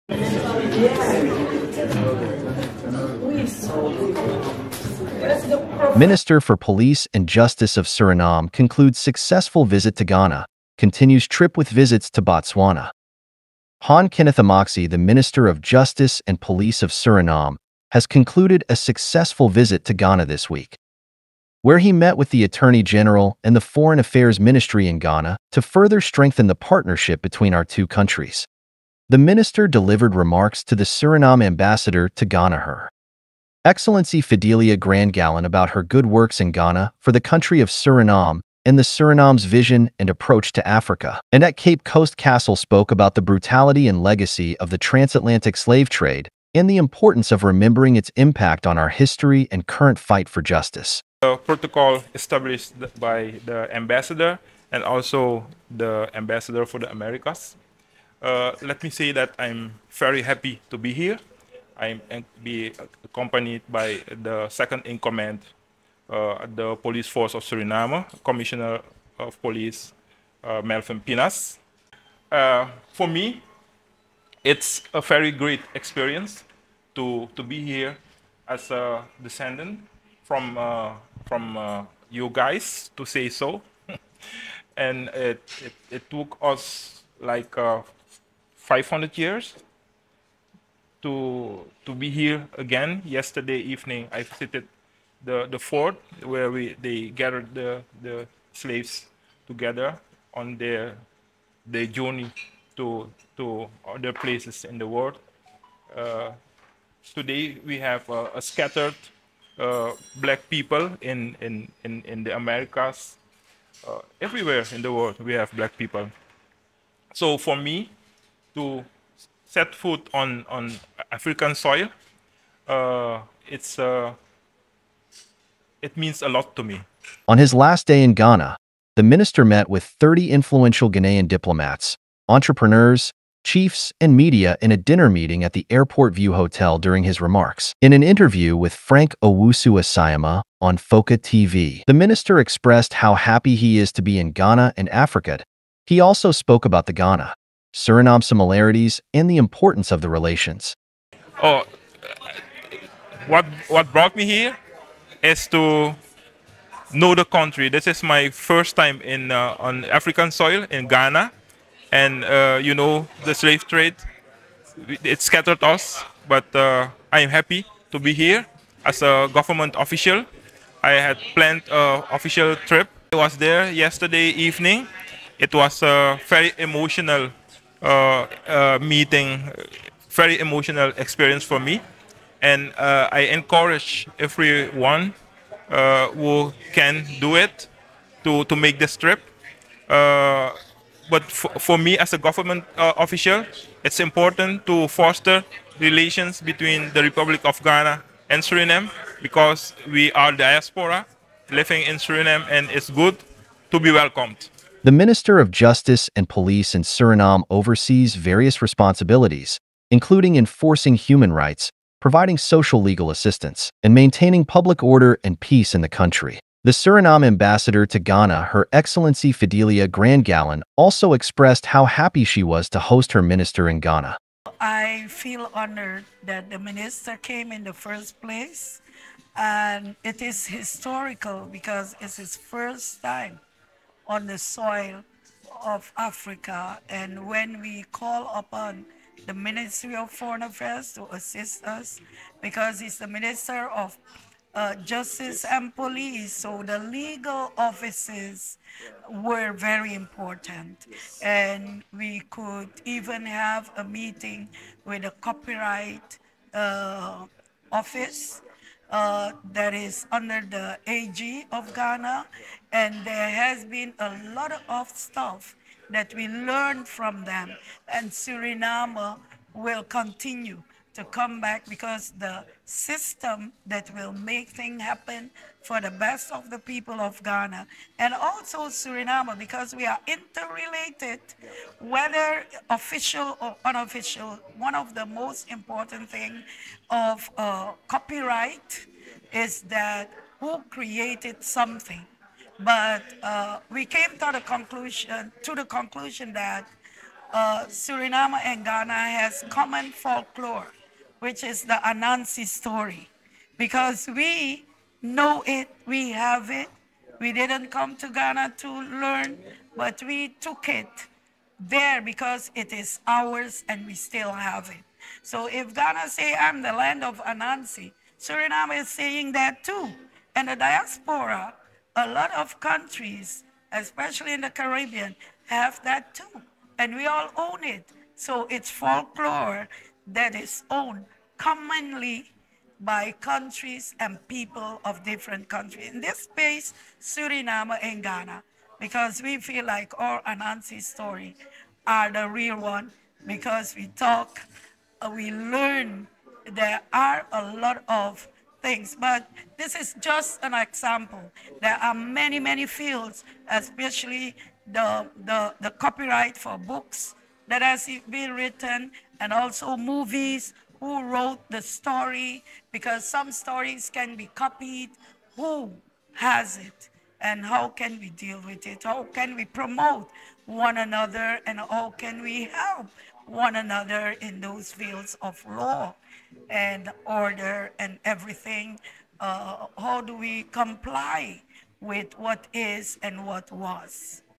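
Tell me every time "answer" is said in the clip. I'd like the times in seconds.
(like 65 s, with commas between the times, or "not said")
not said.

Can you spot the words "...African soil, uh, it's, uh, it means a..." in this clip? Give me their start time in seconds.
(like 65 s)
121 s.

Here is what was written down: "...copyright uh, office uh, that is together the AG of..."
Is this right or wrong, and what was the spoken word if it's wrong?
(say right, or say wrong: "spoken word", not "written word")
wrong: "under", not "together".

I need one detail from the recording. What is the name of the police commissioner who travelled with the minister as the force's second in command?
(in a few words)
Melvin Pinas.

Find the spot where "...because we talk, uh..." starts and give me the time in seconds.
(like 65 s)
343 s.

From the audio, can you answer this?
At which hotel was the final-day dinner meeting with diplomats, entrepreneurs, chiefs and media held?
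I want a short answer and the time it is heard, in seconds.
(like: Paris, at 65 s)
Airport View Hotel, at 135 s.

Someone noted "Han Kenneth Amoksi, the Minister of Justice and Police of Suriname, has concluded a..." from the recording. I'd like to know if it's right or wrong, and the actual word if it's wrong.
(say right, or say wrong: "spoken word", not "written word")
right.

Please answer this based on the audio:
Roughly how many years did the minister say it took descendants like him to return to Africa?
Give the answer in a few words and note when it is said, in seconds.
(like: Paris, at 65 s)
500, at 88 s.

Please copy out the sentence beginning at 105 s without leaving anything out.
Uh, today we have a scattered uh, black people in in in, in the Americas.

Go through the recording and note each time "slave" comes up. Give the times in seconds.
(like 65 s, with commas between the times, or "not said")
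45 s, 98 s, 163 s.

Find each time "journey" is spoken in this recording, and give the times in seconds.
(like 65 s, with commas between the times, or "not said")
101 s.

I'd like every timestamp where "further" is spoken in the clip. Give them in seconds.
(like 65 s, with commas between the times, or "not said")
25 s.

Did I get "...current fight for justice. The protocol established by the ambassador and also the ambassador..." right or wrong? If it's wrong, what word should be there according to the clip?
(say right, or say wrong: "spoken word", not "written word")
right.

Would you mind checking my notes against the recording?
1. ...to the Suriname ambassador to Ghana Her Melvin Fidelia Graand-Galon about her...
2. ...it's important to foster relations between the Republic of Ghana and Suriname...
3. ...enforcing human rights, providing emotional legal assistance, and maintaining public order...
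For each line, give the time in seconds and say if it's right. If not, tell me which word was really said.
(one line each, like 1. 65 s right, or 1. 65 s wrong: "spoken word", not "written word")
1. 30 s wrong: "Excellency", not "Melvin"
2. 193 s right
3. 210 s wrong: "social", not "emotional".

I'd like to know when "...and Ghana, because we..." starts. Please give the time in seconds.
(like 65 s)
337 s.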